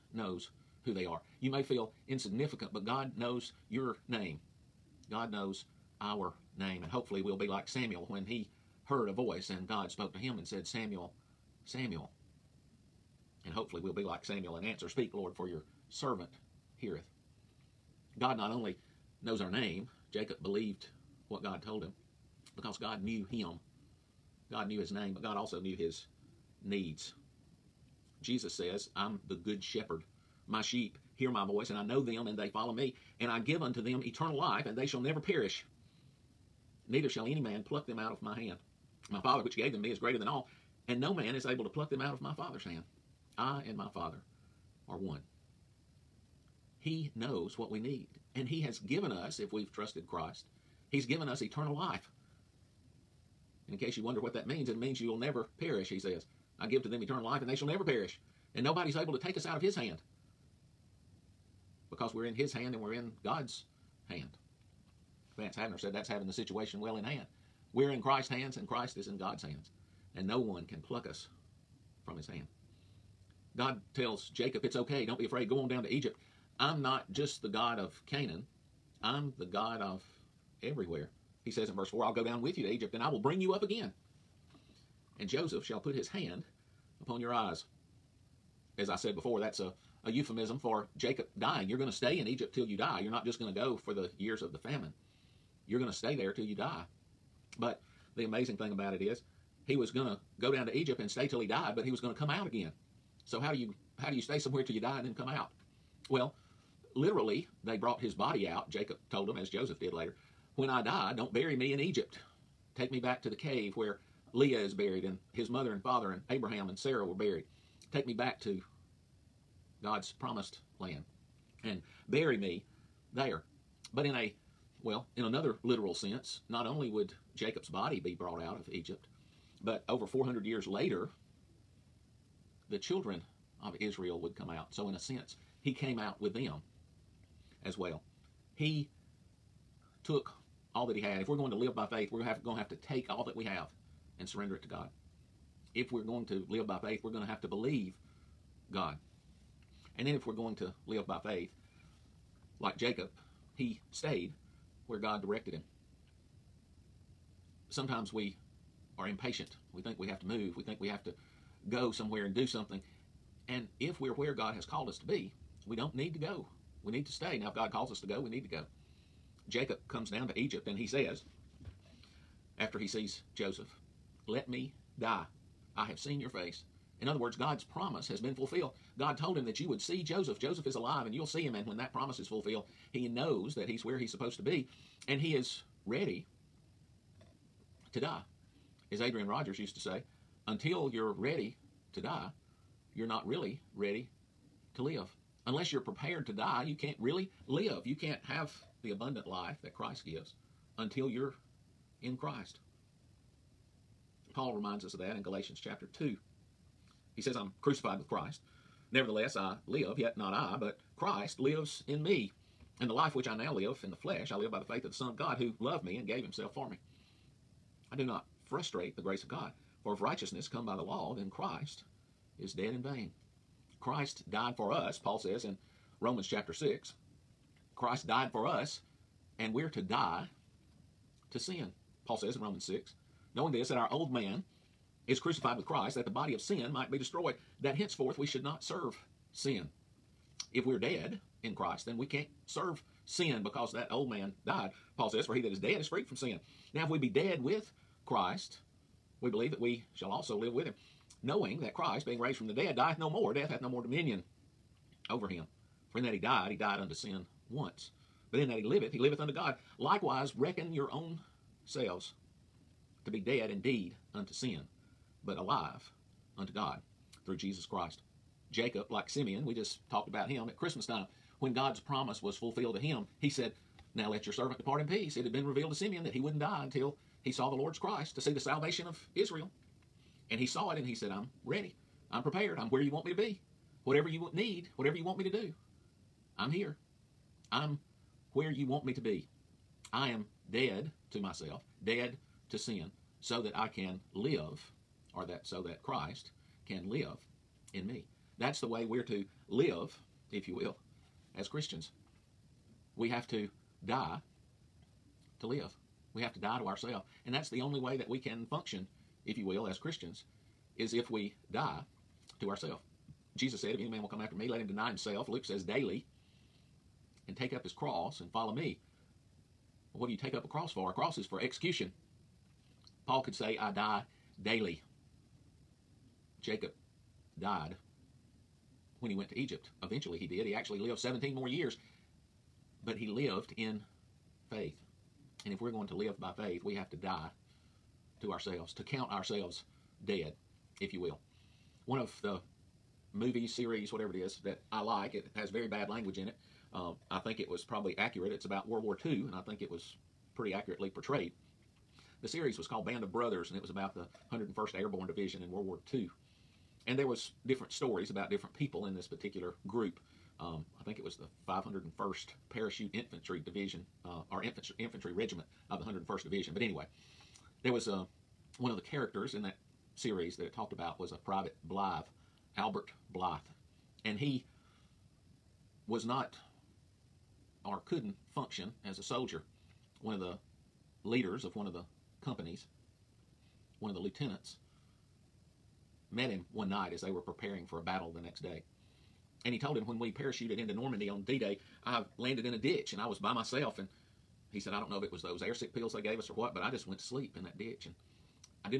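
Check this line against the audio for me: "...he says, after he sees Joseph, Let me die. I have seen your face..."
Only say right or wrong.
right.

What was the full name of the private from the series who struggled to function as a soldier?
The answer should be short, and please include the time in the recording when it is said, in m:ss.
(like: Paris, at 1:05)
Albert Blythe, at 6:12.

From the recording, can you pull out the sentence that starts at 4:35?
It had been revealed to Simeon that he wouldn't die until he saw the Lord's Christ to see the salvation of Israel.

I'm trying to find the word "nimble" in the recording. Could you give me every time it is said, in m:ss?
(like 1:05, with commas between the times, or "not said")
not said.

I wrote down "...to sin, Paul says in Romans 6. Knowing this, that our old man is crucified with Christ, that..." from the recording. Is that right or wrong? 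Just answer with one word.
right.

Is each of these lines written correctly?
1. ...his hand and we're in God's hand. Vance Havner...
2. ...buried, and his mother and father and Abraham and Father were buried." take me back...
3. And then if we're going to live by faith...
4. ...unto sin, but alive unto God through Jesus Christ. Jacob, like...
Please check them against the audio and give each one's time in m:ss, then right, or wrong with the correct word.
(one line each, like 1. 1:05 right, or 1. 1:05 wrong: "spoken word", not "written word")
1. 1:02 right
2. 1:54 wrong: "Sarah", not "Father"
3. 2:29 right
4. 4:24 right.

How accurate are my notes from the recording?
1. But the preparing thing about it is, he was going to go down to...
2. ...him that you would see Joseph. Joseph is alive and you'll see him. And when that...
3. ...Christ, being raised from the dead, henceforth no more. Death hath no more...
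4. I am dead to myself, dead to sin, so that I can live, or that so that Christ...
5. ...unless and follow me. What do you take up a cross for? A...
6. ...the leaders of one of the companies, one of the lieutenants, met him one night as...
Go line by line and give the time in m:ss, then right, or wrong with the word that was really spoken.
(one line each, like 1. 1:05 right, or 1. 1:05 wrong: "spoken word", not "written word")
1. 1:37 wrong: "amazing", not "preparing"
2. 2:59 right
3. 4:11 wrong: "dieth", not "henceforth"
4. 4:49 right
5. 5:17 wrong: "cross", not "unless"
6. 6:20 right.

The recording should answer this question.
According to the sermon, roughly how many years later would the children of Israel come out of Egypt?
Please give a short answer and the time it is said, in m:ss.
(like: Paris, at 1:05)
over 400 years, at 2:09.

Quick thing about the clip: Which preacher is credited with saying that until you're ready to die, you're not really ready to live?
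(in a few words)
Adrian Rogers.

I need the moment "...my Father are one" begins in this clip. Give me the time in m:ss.
0:43.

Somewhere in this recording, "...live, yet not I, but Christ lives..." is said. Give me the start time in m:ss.
3:29.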